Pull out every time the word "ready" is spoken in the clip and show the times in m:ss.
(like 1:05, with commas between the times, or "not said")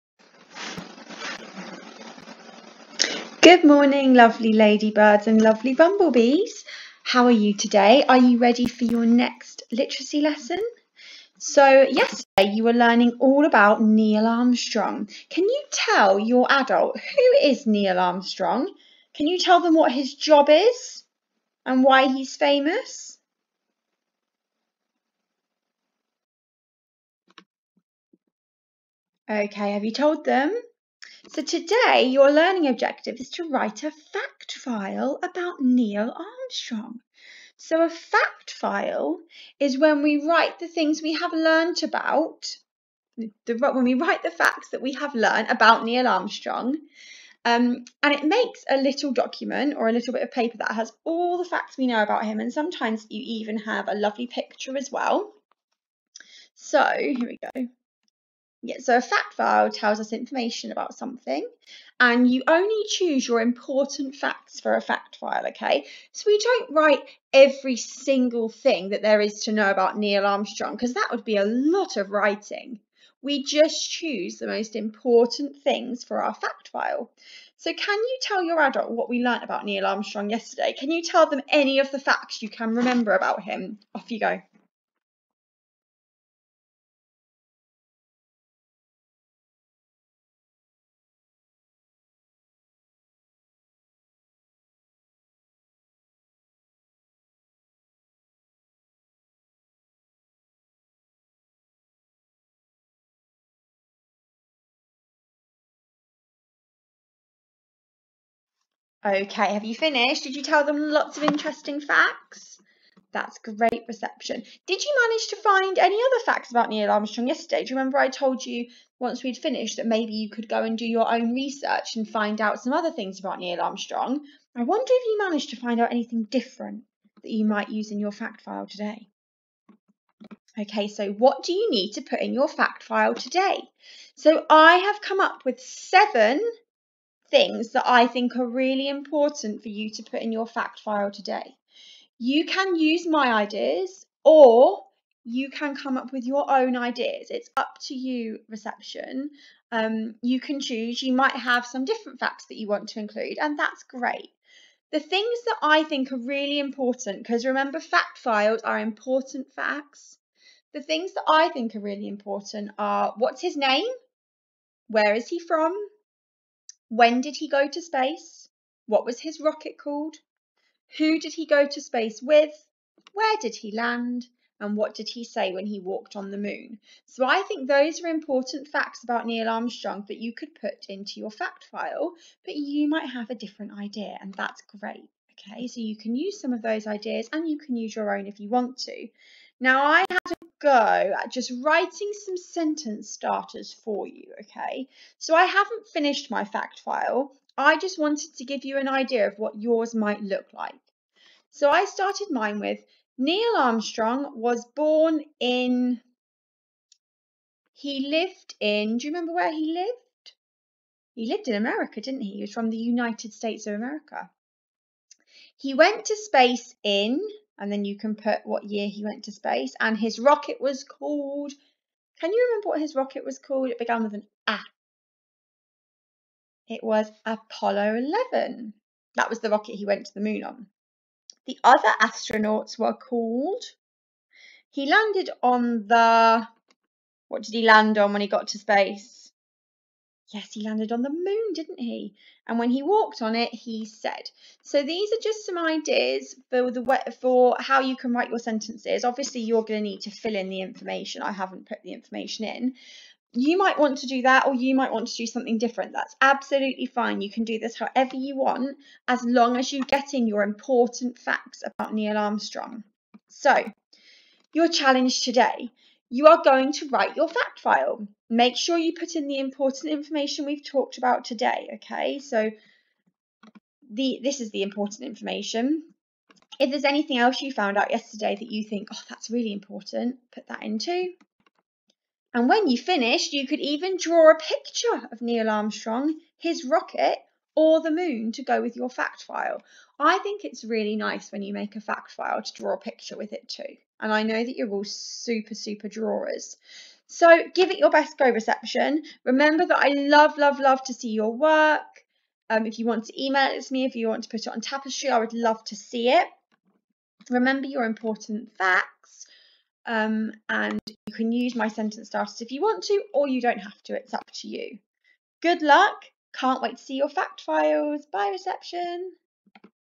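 0:08.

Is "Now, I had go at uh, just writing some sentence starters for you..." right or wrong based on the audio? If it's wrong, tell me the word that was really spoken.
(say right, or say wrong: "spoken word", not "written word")
right.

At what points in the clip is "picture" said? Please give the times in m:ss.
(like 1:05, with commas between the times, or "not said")
0:54, 4:44, 4:52.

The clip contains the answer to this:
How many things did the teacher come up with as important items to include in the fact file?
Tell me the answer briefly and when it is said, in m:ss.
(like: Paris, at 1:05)
7, at 2:15.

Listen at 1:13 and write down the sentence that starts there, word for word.
We just choose the most important things for our fact file.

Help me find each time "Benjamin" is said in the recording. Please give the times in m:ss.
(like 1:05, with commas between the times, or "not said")
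not said.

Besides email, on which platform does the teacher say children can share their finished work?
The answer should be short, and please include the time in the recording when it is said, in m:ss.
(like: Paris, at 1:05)
Tapestry, at 5:04.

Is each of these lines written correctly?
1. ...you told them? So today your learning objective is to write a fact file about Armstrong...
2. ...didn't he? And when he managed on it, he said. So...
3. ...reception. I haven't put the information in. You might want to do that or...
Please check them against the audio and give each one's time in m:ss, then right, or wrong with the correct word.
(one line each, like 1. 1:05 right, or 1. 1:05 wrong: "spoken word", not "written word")
1. 0:29 wrong: "Neil", not "Armstrong"
2. 4:01 wrong: "walked", not "managed"
3. 4:10 wrong: "information", not "reception".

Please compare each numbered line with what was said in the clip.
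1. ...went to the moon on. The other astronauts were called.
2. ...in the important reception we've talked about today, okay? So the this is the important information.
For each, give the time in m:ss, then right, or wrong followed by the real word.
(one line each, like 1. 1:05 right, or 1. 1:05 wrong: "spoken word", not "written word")
1. 3:49 right
2. 4:29 wrong: "information", not "reception".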